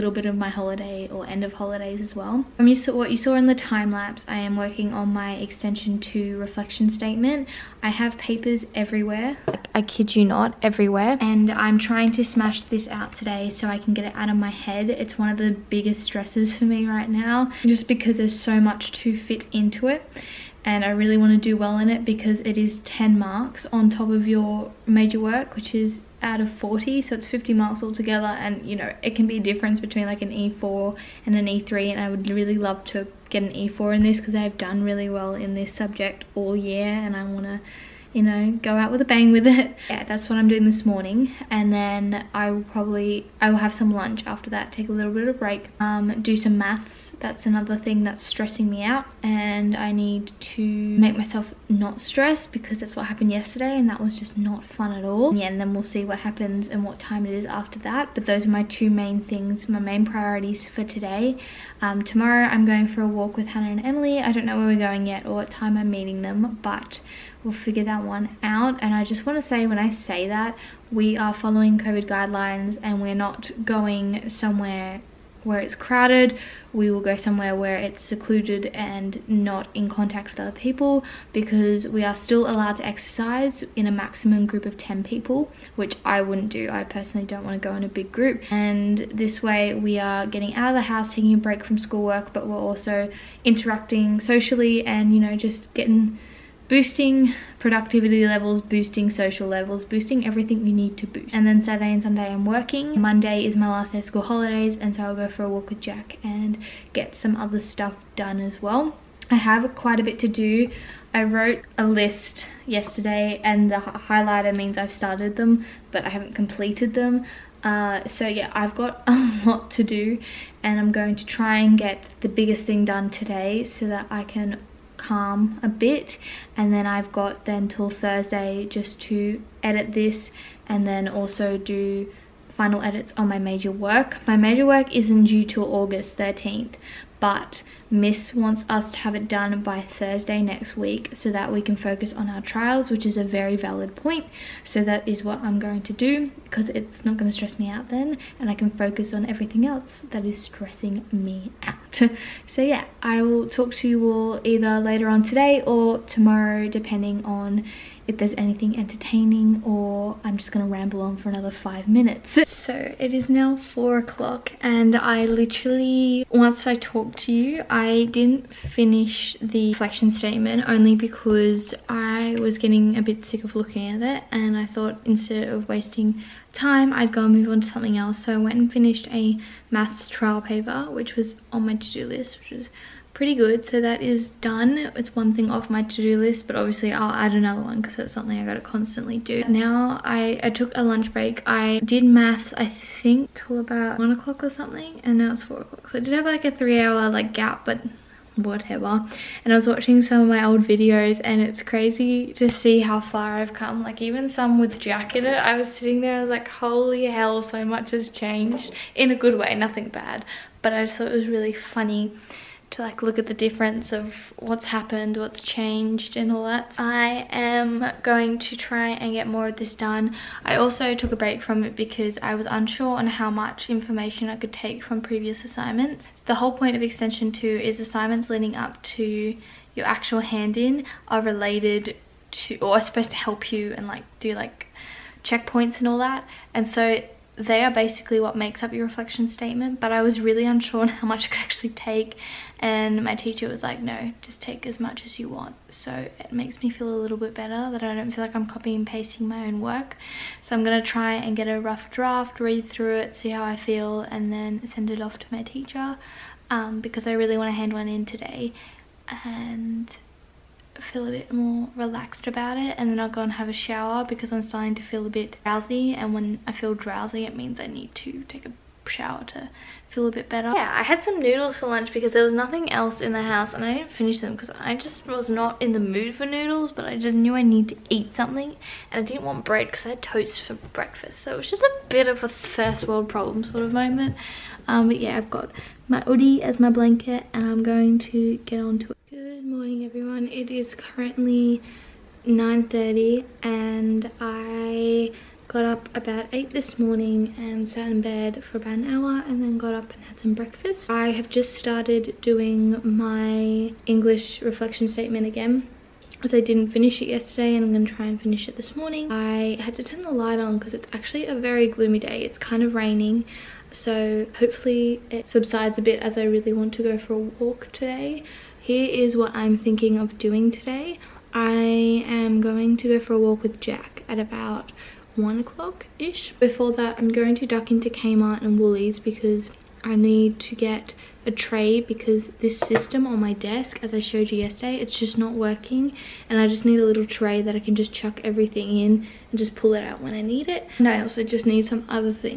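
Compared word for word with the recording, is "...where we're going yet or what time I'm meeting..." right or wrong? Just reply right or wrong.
right.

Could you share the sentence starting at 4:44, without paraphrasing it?
Um, but yeah, I've got my hoodie as my blanket and I'm going to get onto it.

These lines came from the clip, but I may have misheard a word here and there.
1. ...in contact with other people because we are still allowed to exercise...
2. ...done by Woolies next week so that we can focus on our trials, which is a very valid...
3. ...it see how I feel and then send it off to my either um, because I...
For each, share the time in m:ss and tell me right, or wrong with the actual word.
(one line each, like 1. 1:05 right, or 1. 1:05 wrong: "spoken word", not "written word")
1. 1:19 right
2. 2:19 wrong: "Thursday", not "Woolies"
3. 4:12 wrong: "teacher", not "either".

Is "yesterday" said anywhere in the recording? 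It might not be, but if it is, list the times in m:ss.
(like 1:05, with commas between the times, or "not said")
0:53, 1:52, 5:07, 5:34.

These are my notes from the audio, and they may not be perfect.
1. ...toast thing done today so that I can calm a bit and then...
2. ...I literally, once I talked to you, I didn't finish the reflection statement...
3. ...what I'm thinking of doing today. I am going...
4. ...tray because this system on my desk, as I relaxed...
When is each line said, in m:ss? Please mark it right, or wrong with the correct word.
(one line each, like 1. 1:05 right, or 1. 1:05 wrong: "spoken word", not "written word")
1. 2:02 wrong: "biggest", not "toast"
2. 2:44 right
3. 5:19 right
4. 5:31 wrong: "showed", not "relaxed".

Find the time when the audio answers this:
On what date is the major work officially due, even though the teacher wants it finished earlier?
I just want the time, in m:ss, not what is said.
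2:15.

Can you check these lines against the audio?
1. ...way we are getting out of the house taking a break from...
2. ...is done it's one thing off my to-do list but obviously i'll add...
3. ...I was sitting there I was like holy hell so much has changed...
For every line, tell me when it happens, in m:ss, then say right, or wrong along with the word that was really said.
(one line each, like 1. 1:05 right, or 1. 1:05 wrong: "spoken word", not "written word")
1. 1:29 right
2. 3:04 right
3. 3:25 right.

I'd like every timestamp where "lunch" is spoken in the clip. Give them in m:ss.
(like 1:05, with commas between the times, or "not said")
0:43, 3:10, 4:31.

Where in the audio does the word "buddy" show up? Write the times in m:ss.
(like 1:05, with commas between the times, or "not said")
not said.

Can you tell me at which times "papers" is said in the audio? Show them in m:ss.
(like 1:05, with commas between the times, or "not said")
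0:08, 3:00.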